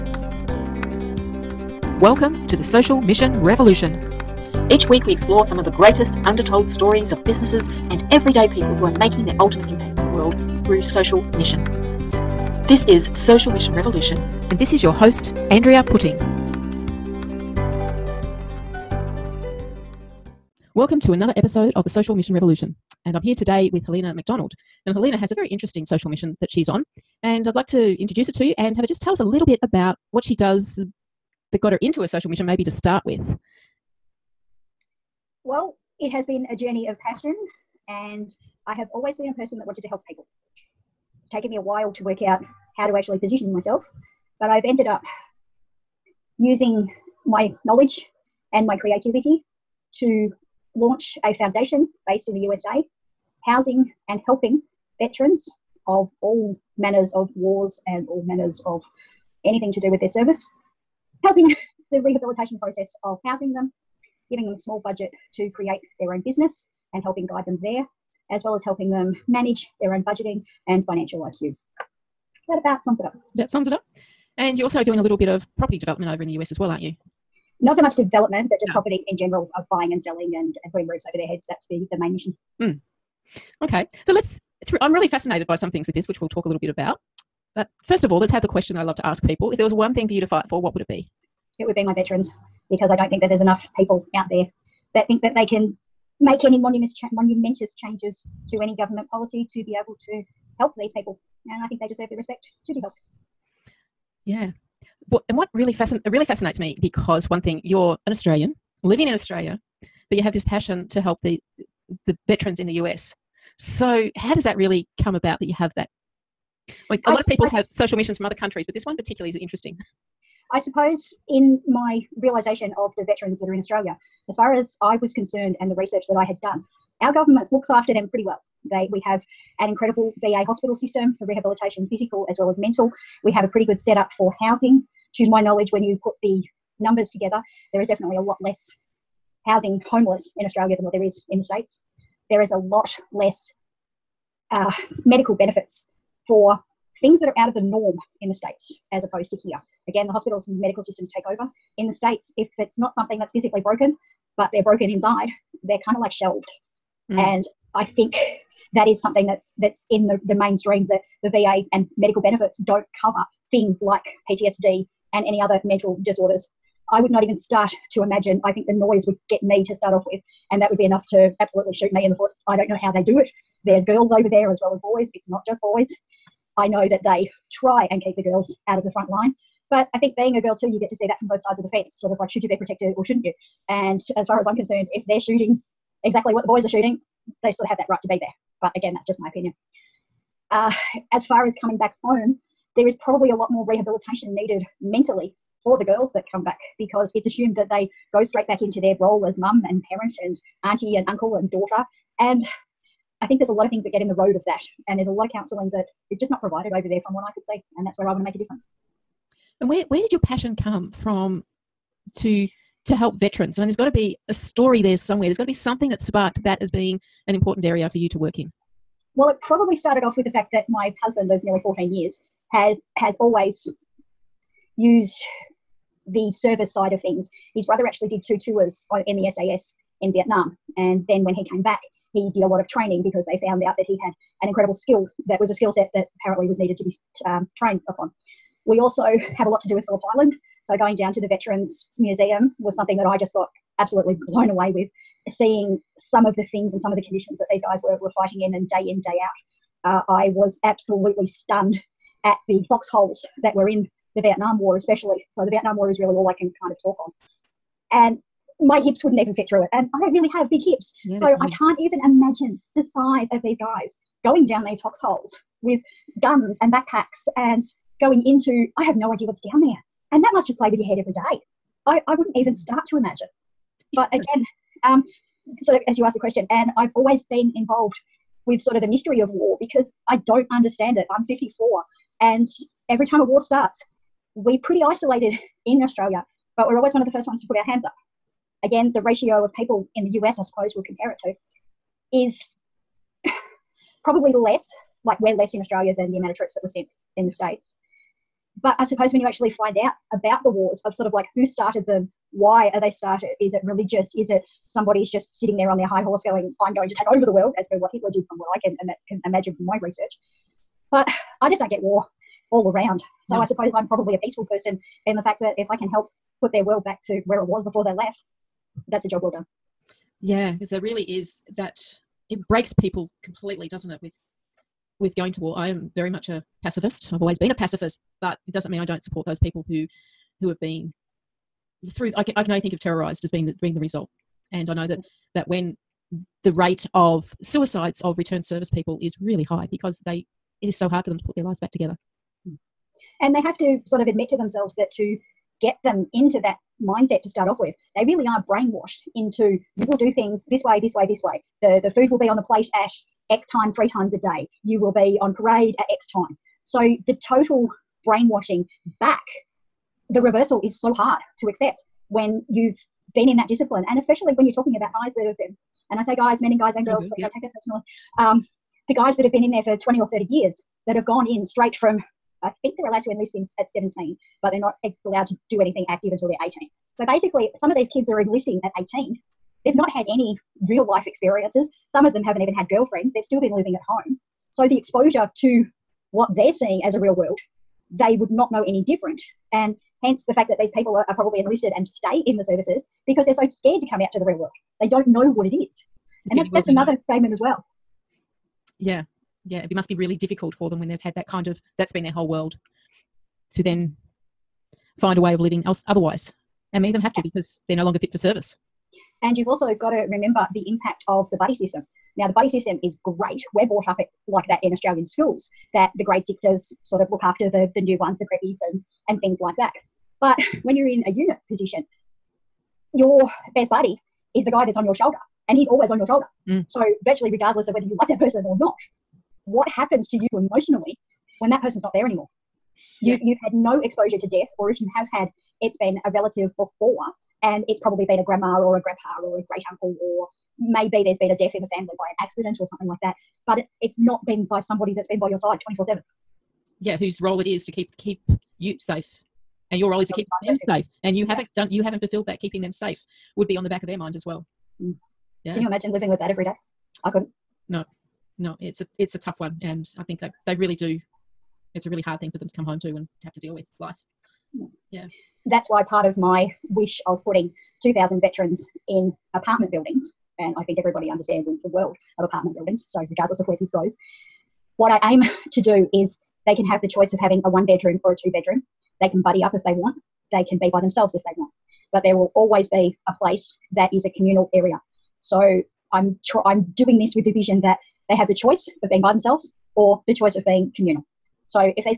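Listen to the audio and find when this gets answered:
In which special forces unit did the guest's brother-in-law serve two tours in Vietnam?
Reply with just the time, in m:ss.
3:49.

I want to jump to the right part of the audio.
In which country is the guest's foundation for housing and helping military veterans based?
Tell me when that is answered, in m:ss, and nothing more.
0:52.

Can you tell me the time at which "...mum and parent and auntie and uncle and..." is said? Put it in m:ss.
3:19.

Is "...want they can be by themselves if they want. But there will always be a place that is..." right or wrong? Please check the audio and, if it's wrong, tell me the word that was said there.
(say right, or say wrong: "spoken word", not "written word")
right.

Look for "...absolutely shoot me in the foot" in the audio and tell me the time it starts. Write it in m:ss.
2:51.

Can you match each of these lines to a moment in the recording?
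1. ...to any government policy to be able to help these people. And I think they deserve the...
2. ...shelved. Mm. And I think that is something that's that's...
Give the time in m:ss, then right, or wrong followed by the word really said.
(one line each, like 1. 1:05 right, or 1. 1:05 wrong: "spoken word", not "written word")
1. 1:38 right
2. 2:36 right.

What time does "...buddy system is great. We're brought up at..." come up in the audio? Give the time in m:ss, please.
6:52.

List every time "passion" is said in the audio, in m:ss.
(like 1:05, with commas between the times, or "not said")
0:36, 1:50, 3:30.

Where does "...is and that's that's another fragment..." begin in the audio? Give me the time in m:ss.
6:35.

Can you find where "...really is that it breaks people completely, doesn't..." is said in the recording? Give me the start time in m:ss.
5:20.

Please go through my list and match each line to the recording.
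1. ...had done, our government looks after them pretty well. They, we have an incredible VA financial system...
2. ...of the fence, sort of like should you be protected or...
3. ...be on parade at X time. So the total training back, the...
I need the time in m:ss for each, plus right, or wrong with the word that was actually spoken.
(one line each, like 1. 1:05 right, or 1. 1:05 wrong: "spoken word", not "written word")
1. 2:06 wrong: "hospital", not "financial"
2. 3:01 right
3. 5:54 wrong: "brainwashing", not "training".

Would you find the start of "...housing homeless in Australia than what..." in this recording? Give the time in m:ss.
2:19.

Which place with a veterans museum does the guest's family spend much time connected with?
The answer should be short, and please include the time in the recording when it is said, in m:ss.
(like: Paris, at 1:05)
Phillip Island, at 3:59.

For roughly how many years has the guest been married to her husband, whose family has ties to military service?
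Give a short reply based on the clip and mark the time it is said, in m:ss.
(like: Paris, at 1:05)
nearly 14 years, at 3:41.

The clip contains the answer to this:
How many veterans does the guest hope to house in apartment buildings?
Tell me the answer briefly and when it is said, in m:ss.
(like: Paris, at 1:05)
2,000, at 7:47.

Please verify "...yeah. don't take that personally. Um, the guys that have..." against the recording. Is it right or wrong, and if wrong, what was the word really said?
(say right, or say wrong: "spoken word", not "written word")
right.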